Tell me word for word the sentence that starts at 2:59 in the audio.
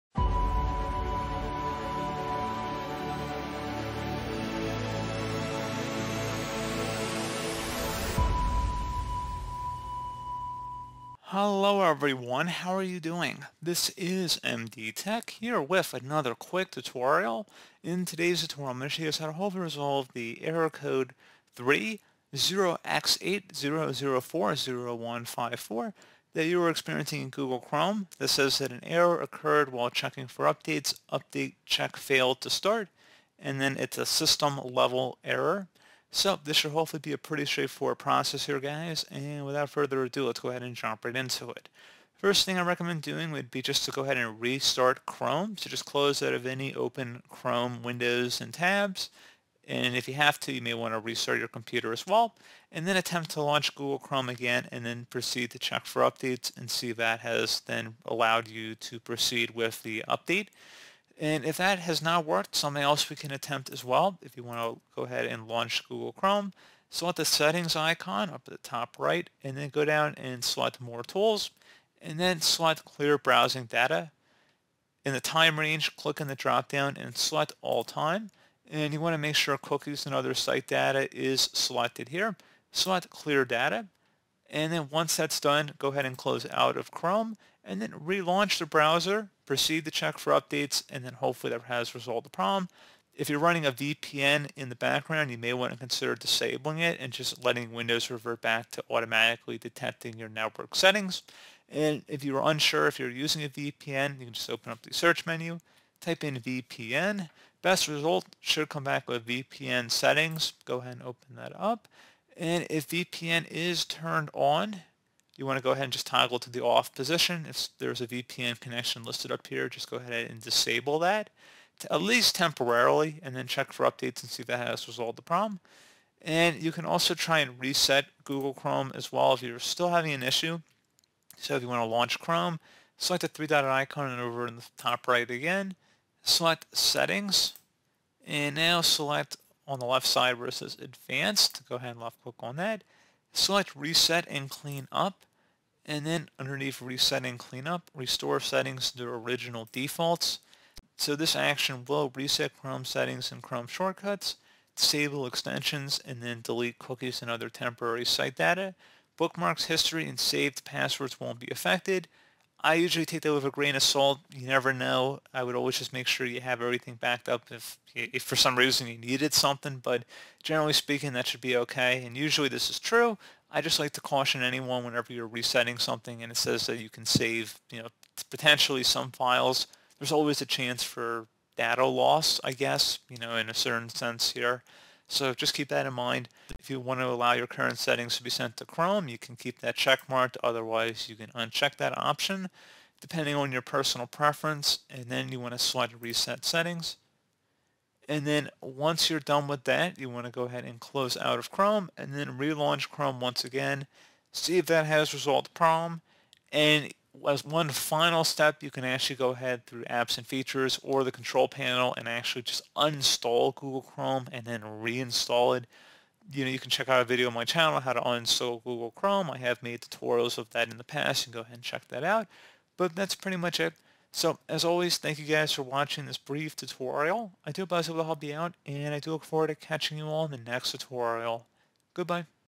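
There's always a chance for data loss, I guess, you know, in a certain sense here.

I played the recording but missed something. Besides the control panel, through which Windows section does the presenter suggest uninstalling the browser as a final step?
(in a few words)
Apps and features.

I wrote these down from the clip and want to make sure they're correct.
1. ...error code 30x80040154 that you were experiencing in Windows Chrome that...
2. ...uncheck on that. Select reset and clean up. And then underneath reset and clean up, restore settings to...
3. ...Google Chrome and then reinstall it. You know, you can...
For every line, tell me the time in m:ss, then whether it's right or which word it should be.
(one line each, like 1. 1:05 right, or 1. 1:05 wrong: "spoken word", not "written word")
1. 0:20 wrong: "Google", not "Windows"
2. 2:22 wrong: "click", not "uncheck"
3. 3:33 right.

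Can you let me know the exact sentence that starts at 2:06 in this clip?
And you can also try and reset Google Chrome as well if you're still having an issue.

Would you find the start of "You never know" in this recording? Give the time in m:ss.
2:44.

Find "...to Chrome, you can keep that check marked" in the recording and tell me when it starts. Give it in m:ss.
3:08.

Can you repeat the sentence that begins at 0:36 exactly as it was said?
So this should hopefully be a pretty straightforward process here, guys.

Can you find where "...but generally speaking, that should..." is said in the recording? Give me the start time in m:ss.
2:49.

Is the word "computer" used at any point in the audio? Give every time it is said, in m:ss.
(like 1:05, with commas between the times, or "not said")
0:51.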